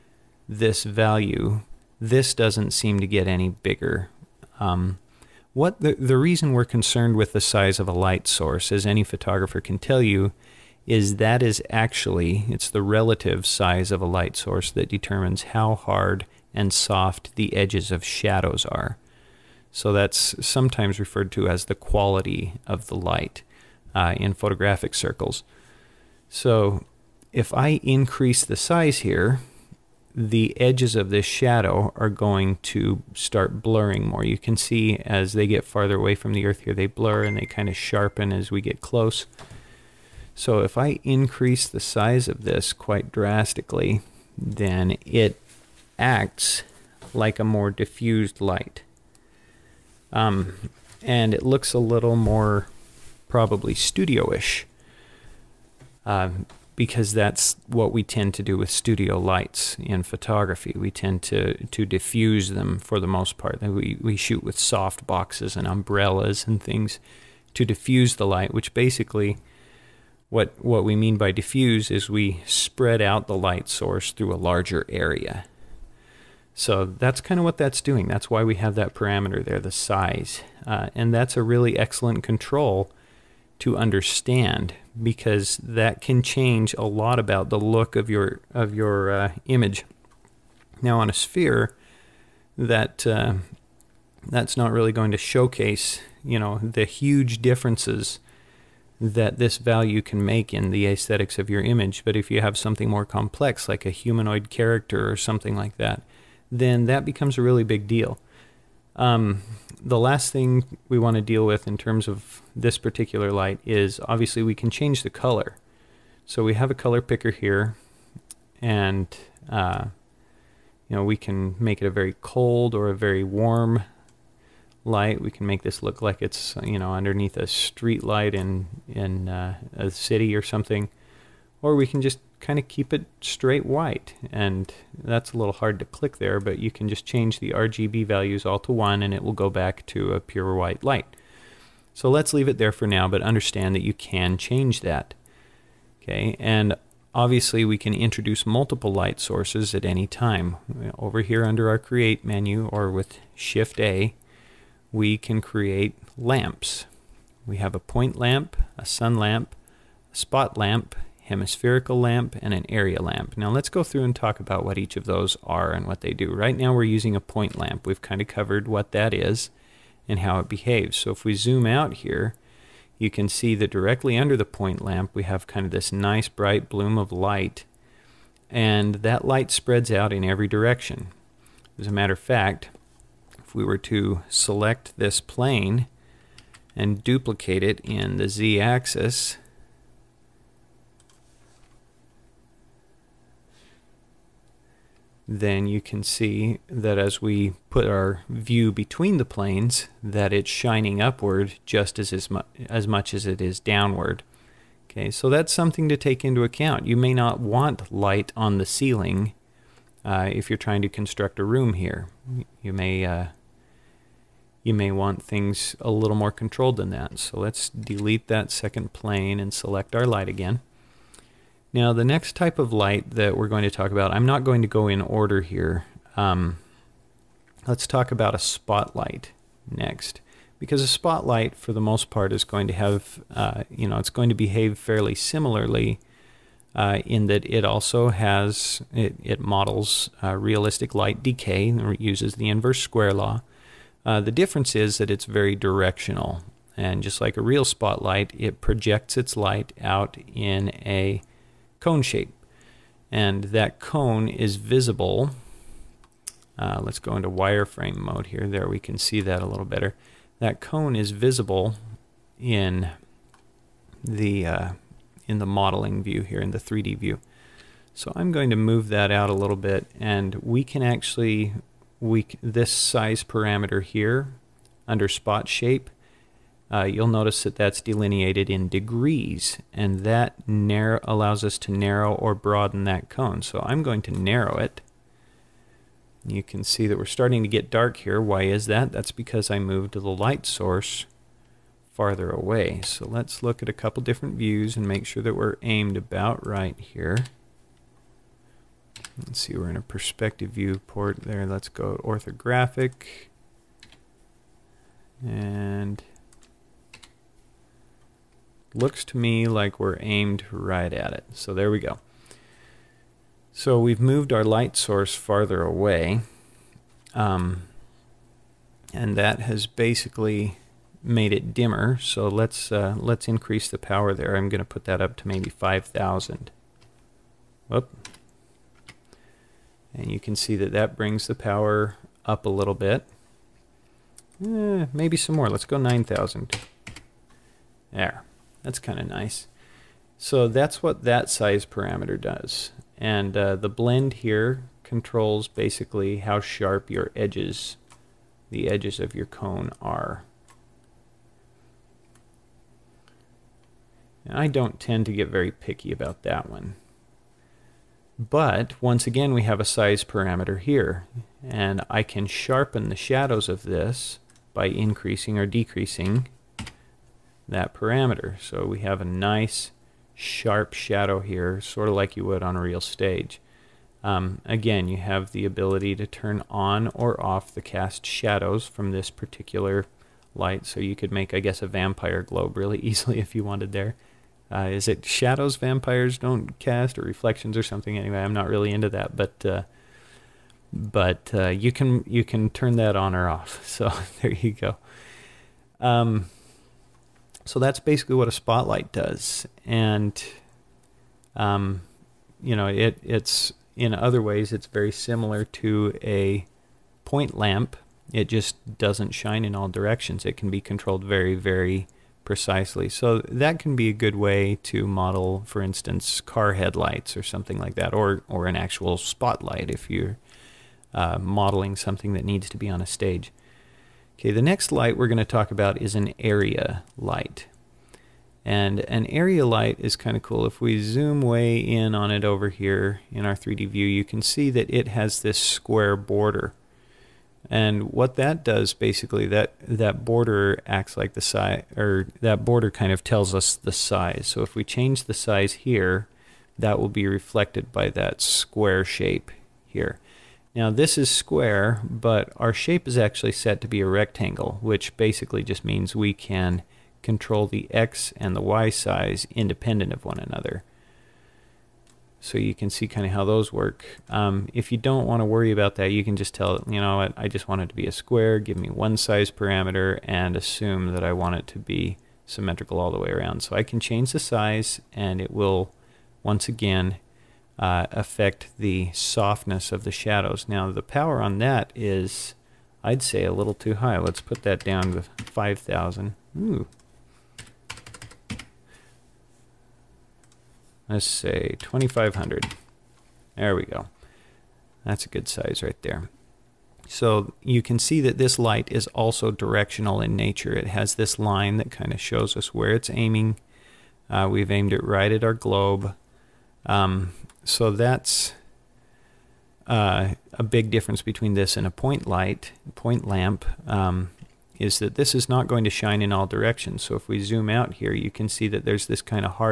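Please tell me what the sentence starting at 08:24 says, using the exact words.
Uh, we've aimed it right at our globe.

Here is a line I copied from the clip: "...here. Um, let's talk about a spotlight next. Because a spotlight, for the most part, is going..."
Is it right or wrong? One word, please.
right.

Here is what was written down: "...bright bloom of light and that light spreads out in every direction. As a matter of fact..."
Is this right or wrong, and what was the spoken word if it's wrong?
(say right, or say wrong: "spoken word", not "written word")
right.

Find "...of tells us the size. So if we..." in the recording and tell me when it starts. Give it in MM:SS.
07:22.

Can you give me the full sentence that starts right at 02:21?
So let's leave it there for now, but understand that you can change that.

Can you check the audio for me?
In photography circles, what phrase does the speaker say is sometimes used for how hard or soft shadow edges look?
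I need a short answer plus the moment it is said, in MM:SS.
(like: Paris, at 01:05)
quality of the light, at 00:21.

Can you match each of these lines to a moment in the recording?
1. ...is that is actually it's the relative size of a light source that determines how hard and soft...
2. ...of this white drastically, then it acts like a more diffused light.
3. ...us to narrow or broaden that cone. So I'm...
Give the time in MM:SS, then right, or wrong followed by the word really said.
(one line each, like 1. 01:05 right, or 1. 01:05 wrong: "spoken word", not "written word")
1. 00:10 right
2. 00:42 wrong: "quite", not "white"
3. 04:41 right.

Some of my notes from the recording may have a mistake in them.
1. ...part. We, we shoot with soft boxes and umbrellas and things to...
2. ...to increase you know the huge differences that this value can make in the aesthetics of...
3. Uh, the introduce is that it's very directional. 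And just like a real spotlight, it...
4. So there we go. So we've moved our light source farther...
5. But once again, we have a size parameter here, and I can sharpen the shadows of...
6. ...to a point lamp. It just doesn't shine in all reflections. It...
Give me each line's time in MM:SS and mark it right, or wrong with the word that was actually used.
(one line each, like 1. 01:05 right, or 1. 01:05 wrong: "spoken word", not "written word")
1. 01:03 right
2. 01:35 wrong: "showcase", not "increase"
3. 04:04 wrong: "difference", not "introduce"
4. 05:11 right
5. 05:58 right
6. 06:45 wrong: "directions", not "reflections".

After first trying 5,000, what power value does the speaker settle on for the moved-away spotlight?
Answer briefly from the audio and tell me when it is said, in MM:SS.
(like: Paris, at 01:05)
9,000, at 05:35.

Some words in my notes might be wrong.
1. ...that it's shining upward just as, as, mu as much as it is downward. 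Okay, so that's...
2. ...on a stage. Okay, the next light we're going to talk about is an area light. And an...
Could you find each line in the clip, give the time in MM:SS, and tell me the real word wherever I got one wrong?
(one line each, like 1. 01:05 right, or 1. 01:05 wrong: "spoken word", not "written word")
1. 03:20 right
2. 07:02 right.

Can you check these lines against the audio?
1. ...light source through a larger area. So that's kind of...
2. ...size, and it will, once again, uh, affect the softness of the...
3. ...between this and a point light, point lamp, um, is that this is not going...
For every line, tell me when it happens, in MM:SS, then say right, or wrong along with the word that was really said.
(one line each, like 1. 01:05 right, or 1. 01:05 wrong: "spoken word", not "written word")
1. 01:13 right
2. 07:54 right
3. 08:31 right.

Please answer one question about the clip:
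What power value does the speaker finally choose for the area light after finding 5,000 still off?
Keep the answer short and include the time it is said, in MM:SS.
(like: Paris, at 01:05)
2,500, at 08:11.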